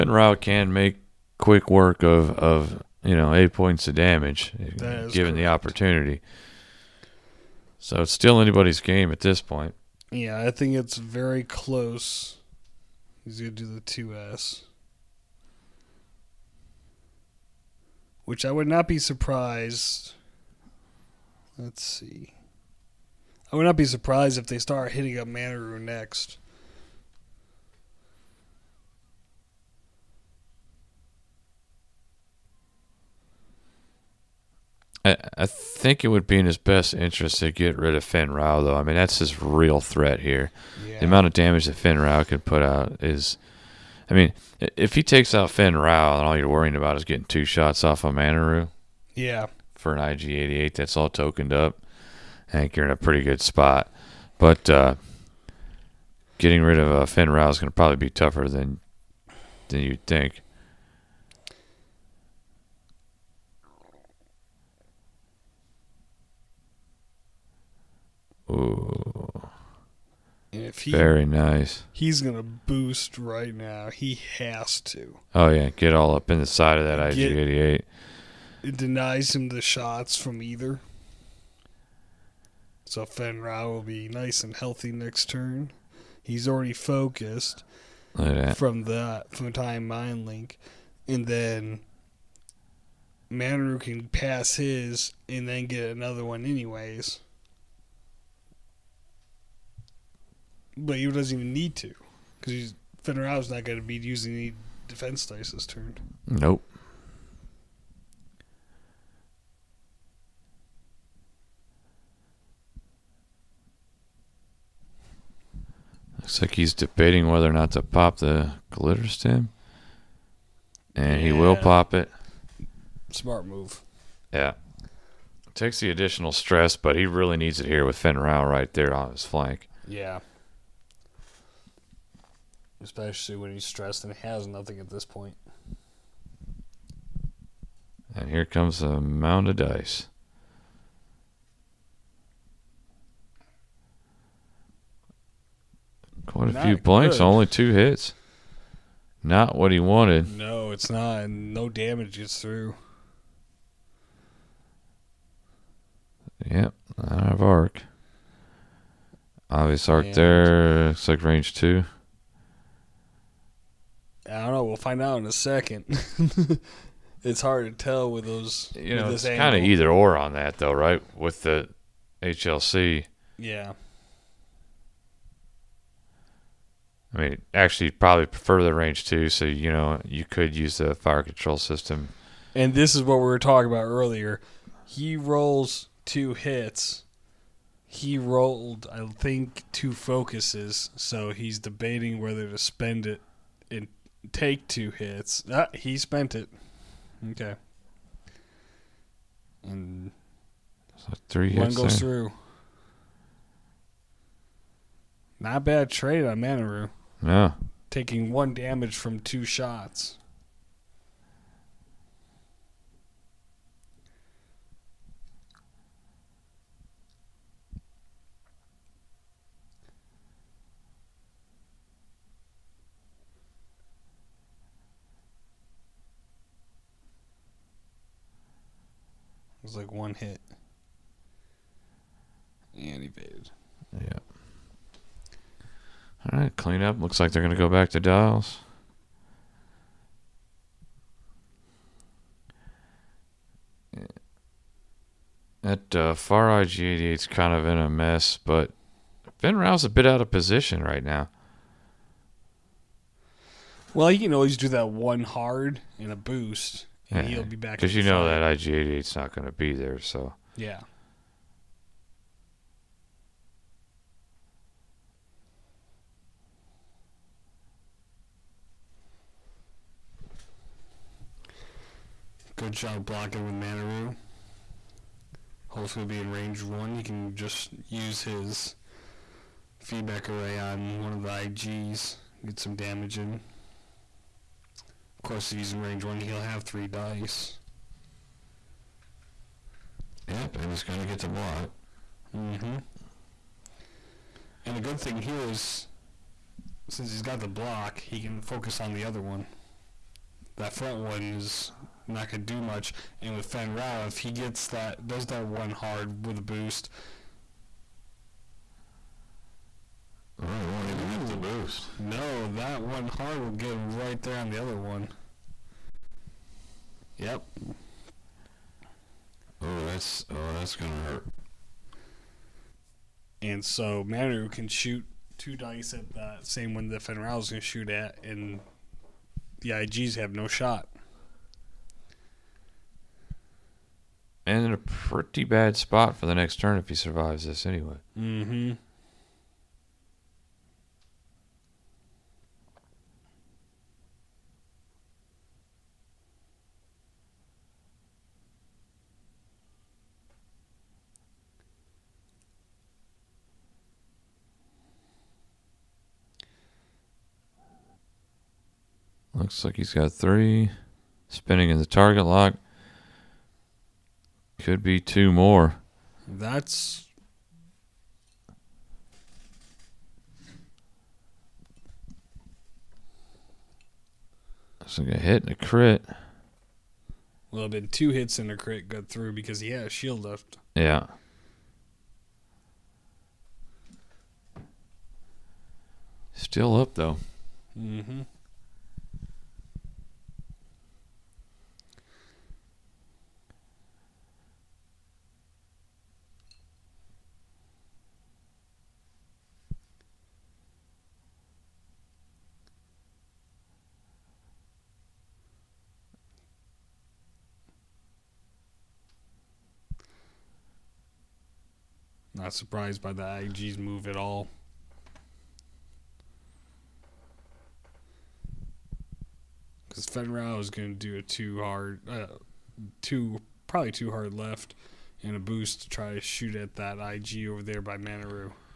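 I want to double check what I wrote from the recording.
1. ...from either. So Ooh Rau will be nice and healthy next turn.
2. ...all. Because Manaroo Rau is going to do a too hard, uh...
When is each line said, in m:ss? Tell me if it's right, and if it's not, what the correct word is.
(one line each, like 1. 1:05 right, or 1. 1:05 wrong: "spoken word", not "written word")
1. 1:20 wrong: "Fenn", not "Ooh"
2. 6:54 wrong: "Fenn", not "Manaroo".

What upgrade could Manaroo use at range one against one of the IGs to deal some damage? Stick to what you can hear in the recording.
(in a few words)
Feedback array.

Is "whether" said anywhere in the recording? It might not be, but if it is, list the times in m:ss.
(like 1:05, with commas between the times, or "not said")
1:57, 3:12.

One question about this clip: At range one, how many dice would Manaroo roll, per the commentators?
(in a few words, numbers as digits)
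3.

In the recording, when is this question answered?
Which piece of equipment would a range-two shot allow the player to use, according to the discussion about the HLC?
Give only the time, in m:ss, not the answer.
3:00.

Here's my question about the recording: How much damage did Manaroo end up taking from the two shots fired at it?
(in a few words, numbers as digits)
1.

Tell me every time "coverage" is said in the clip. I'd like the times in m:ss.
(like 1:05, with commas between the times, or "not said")
not said.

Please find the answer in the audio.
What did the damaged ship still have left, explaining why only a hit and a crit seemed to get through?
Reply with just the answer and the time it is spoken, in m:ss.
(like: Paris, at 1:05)
A shield, at 6:19.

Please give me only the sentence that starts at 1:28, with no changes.
from that from time mind link, and then Manaroo can pass his and then get another one anyways.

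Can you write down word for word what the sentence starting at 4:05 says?
That uh, Far Eye g is kind of in a mess, but Fenn Rau's a bit out of position right now.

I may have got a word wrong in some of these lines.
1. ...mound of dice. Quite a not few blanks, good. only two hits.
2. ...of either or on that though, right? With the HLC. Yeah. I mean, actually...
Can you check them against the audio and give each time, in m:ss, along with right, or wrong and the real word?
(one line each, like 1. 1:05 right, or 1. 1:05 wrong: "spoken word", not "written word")
1. 2:19 right
2. 2:49 right.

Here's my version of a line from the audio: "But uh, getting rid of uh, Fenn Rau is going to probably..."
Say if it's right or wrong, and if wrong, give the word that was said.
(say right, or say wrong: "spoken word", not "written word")
right.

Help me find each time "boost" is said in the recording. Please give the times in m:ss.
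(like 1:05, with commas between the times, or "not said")
1:12, 4:16, 5:06, 5:11, 7:05.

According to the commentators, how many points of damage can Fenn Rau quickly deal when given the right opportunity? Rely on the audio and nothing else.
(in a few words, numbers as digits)
8.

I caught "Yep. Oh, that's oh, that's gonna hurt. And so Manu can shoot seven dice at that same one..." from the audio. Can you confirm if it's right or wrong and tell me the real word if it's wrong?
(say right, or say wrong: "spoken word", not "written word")
wrong: "two", not "seven".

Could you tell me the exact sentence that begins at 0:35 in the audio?
I, I think it would be in his best interest to get rid of Fenn Rau, though.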